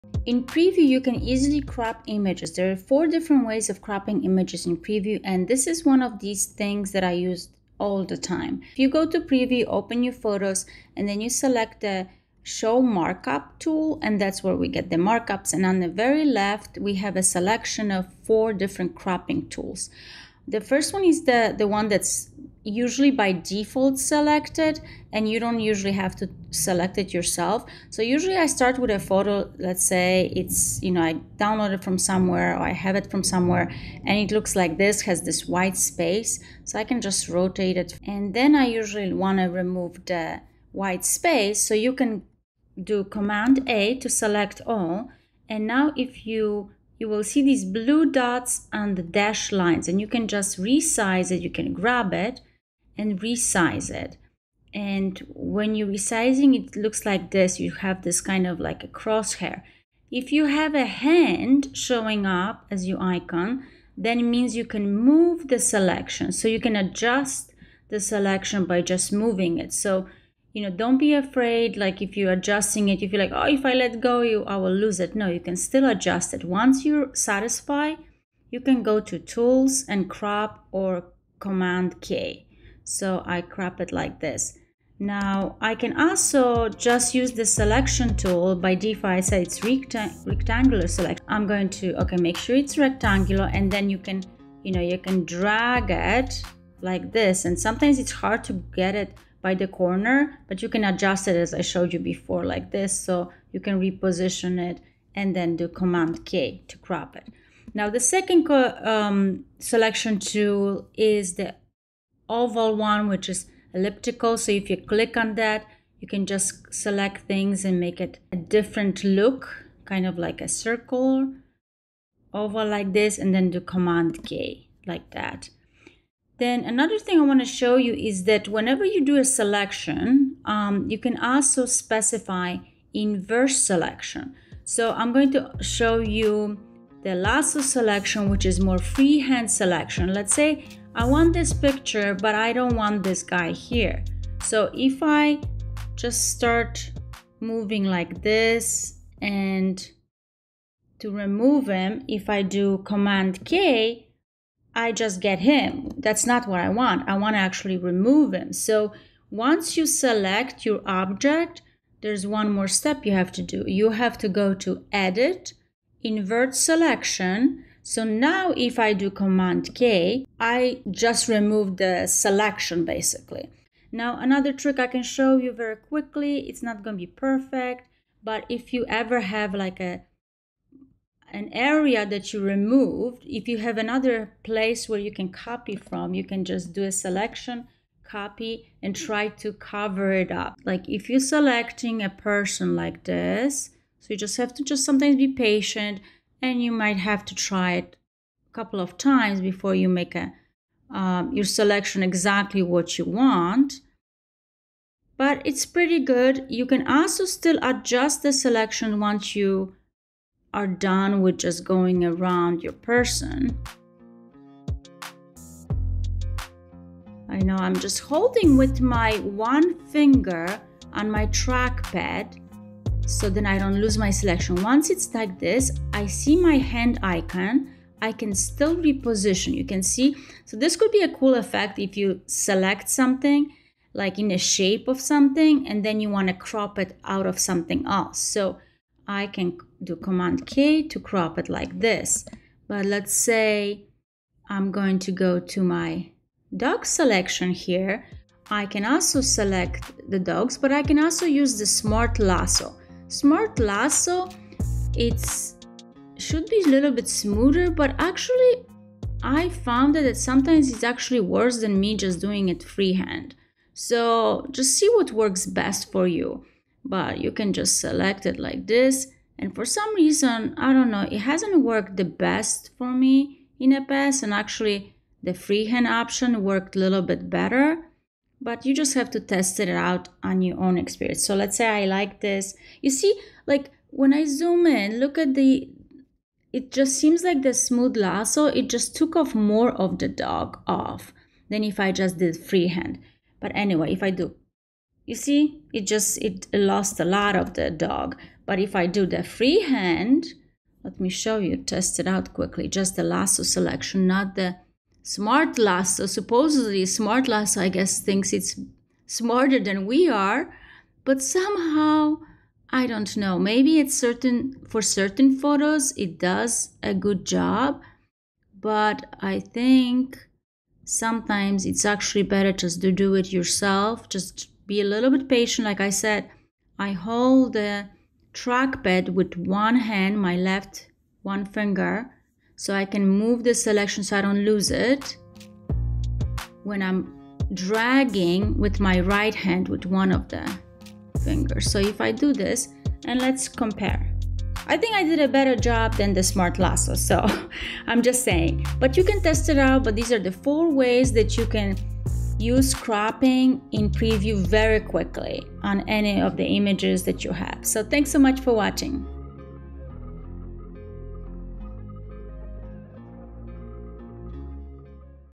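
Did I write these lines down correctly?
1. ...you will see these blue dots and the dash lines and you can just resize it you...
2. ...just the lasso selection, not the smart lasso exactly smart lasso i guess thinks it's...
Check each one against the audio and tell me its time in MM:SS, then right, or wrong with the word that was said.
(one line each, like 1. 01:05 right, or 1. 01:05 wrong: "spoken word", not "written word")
1. 00:46 right
2. 05:02 wrong: "supposedly", not "exactly".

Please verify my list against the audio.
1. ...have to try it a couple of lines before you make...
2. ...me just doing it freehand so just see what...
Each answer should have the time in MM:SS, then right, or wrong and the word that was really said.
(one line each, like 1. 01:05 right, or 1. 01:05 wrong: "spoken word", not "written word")
1. 03:16 wrong: "times", not "lines"
2. 04:21 right.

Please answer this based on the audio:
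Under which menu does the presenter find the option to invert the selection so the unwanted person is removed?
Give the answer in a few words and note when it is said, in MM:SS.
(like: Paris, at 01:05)
Edit, at 02:44.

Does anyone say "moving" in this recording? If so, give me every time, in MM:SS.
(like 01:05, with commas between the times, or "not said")
01:09, 02:27.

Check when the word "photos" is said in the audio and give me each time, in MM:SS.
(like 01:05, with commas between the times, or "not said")
00:10, 00:28, 05:15.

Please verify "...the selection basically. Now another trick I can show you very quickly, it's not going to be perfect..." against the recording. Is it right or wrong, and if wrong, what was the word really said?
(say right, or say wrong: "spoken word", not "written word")
right.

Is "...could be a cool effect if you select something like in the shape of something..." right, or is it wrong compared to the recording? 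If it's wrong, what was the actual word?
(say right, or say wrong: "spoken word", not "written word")
right.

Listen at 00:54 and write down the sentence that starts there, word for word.
And when you're resizing, it looks like this.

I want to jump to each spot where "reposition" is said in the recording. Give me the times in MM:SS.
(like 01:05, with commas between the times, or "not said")
01:43, 03:48.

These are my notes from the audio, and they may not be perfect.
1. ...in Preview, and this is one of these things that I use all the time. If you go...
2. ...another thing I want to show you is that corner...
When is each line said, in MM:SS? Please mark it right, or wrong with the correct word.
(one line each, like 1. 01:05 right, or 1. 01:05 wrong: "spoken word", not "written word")
1. 00:04 right
2. 02:06 wrong: "whenever", not "corner".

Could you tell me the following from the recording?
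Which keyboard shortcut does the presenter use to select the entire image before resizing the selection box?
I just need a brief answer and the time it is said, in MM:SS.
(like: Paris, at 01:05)
Command A, at 00:43.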